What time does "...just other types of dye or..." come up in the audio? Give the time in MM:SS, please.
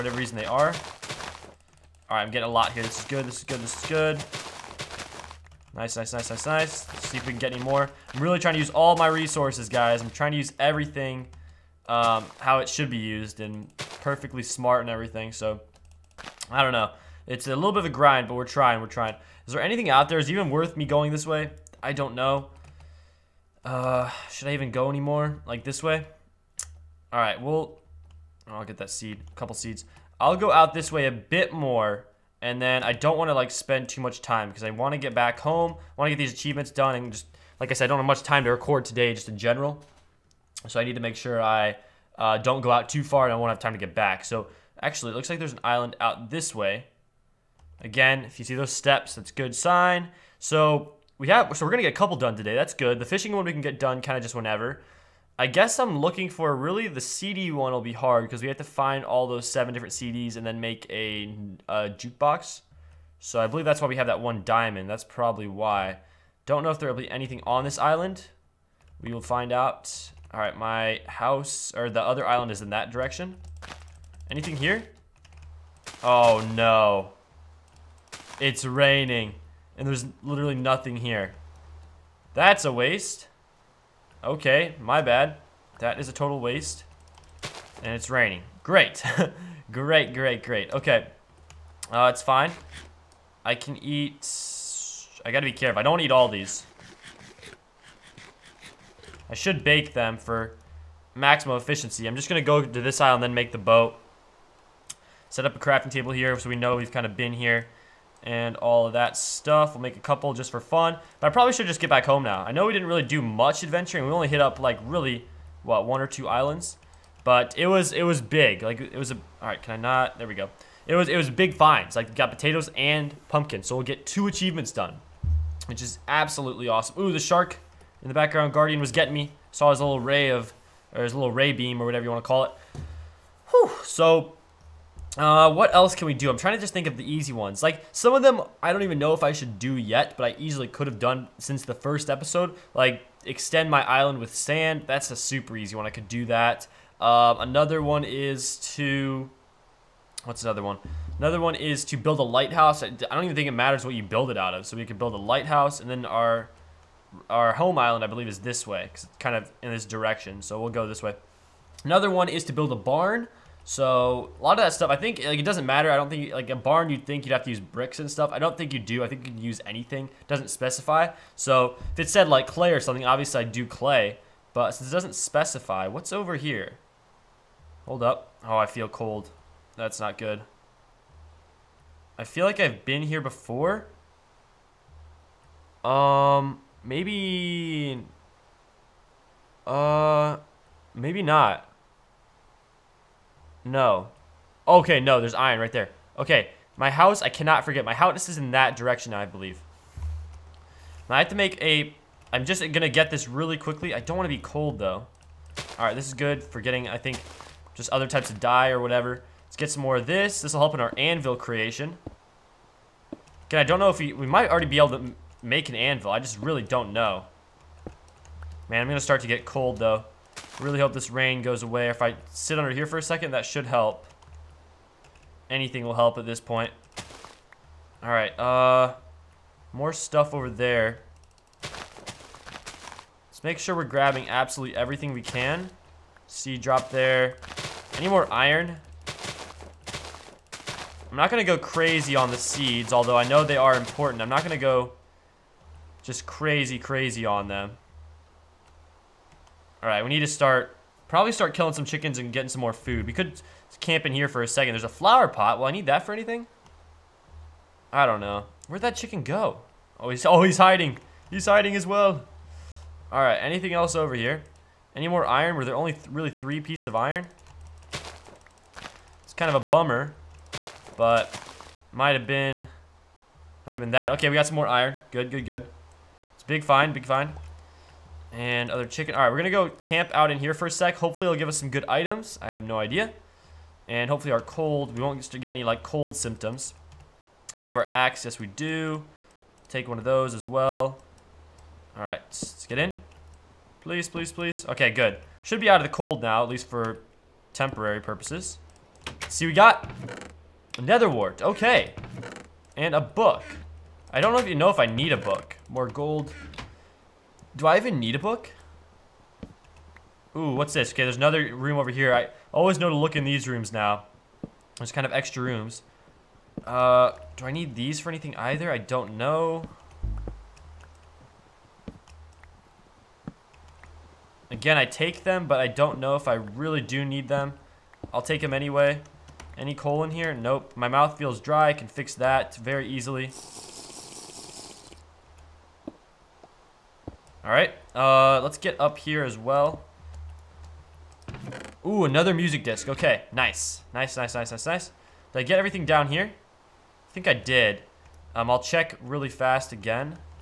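03:27.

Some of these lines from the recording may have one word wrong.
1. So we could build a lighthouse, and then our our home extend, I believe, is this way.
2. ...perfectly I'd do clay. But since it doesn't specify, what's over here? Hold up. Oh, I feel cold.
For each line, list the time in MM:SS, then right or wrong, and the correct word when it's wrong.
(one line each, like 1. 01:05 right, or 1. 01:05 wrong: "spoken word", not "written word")
1. 02:34 wrong: "island", not "extend"
2. 02:53 wrong: "obviously", not "perfectly".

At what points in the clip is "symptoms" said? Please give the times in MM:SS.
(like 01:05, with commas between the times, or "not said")
04:46.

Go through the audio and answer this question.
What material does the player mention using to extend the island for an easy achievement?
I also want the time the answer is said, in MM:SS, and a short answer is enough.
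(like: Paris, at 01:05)
Sand, at 02:24.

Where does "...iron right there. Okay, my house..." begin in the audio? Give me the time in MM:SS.
03:15.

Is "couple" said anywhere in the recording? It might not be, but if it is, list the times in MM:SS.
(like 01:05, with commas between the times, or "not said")
00:29, 00:51, 01:50.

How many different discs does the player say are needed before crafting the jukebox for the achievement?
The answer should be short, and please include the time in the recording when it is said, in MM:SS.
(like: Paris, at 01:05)
7, at 00:59.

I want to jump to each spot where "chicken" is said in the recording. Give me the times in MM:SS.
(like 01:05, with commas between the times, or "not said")
04:11, 04:18, 04:38.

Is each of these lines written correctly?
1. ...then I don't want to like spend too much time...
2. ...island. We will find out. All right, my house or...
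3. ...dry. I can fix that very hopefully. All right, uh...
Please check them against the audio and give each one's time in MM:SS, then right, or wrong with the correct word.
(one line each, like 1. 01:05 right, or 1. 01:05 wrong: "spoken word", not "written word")
1. 00:32 right
2. 01:07 right
3. 05:31 wrong: "easily", not "hopefully".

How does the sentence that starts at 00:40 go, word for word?
So I need to make sure I uh, don't go out too far and I won't have time to get back.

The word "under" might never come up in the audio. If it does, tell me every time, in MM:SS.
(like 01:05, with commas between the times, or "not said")
03:42.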